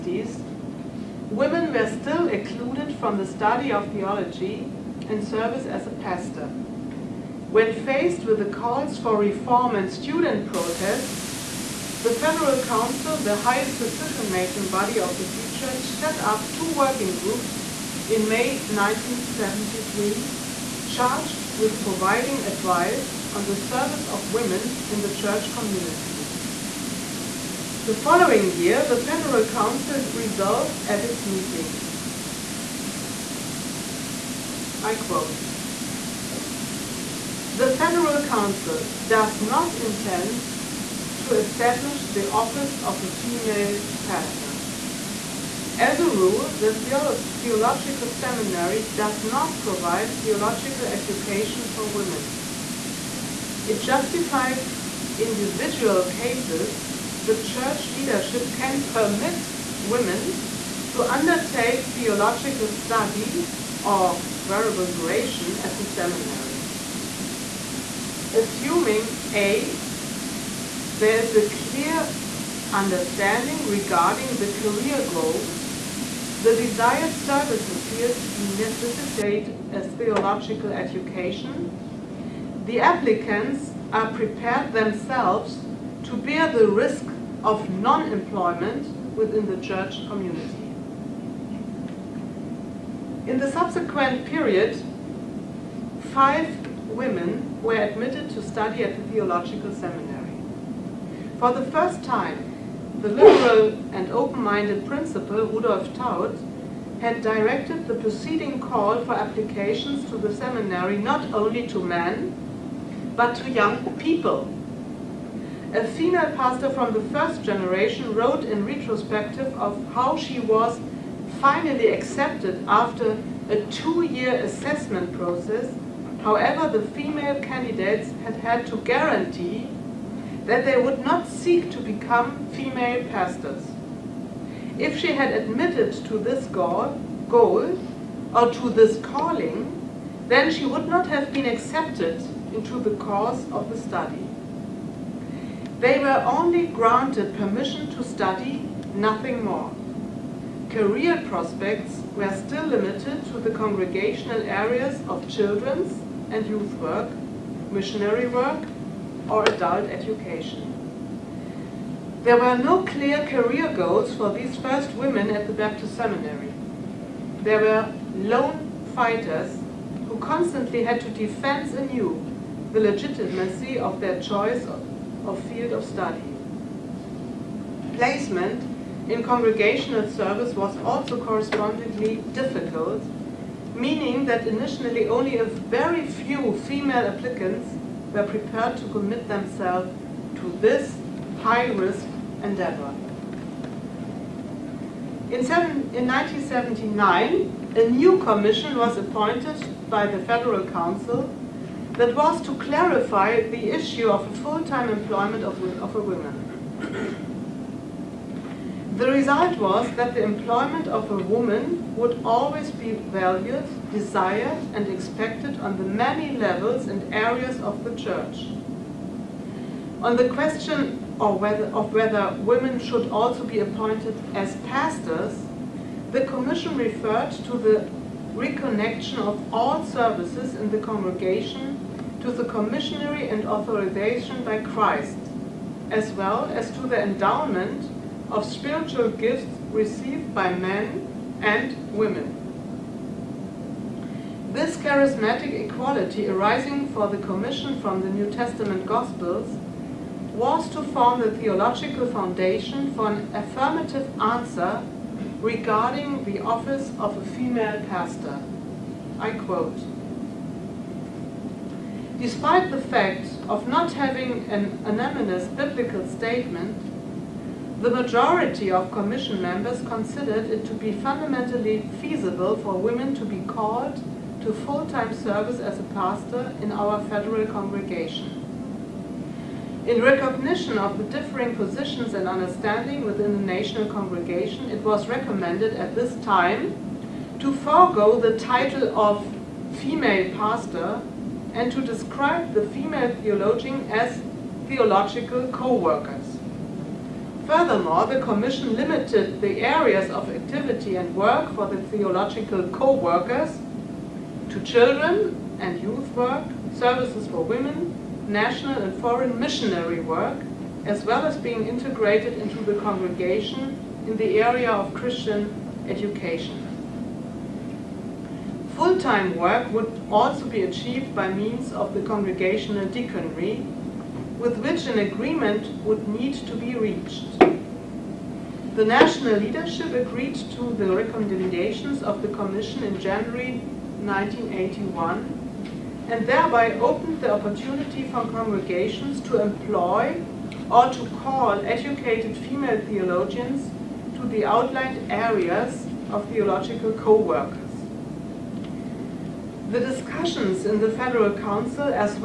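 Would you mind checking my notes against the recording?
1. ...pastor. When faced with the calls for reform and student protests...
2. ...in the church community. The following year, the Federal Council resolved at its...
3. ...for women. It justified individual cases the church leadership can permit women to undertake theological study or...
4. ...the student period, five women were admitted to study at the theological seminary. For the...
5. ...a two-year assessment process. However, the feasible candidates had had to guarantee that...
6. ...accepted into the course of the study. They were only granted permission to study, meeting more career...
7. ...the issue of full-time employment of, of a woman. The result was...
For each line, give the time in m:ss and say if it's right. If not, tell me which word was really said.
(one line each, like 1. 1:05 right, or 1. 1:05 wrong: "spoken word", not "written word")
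1. 0:06 right
2. 0:24 right
3. 0:51 right
4. 1:33 wrong: "subsequent", not "student"
5. 2:03 wrong: "female", not "feasible"
6. 2:21 wrong: "nothing", not "meeting"
7. 3:23 right.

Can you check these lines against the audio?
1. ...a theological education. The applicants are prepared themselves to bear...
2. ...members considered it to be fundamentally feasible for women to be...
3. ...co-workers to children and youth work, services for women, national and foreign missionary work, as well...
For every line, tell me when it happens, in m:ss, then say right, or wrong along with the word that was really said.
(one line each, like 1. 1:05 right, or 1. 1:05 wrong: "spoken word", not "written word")
1. 1:19 right
2. 4:29 right
3. 5:02 right.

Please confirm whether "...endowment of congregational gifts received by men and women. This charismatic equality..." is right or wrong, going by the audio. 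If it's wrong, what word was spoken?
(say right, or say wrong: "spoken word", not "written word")
wrong: "spiritual", not "congregational".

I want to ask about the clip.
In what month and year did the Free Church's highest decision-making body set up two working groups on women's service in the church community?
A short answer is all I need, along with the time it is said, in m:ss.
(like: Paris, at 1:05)
May 1973, at 0:18.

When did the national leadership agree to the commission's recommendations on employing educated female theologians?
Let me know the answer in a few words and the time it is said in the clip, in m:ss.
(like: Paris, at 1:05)
January 1981, at 5:32.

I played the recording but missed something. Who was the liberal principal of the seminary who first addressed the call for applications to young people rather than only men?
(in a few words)
Rudolf Thaut.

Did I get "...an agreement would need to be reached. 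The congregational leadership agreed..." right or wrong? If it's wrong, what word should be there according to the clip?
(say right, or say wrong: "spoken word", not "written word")
wrong: "national", not "congregational".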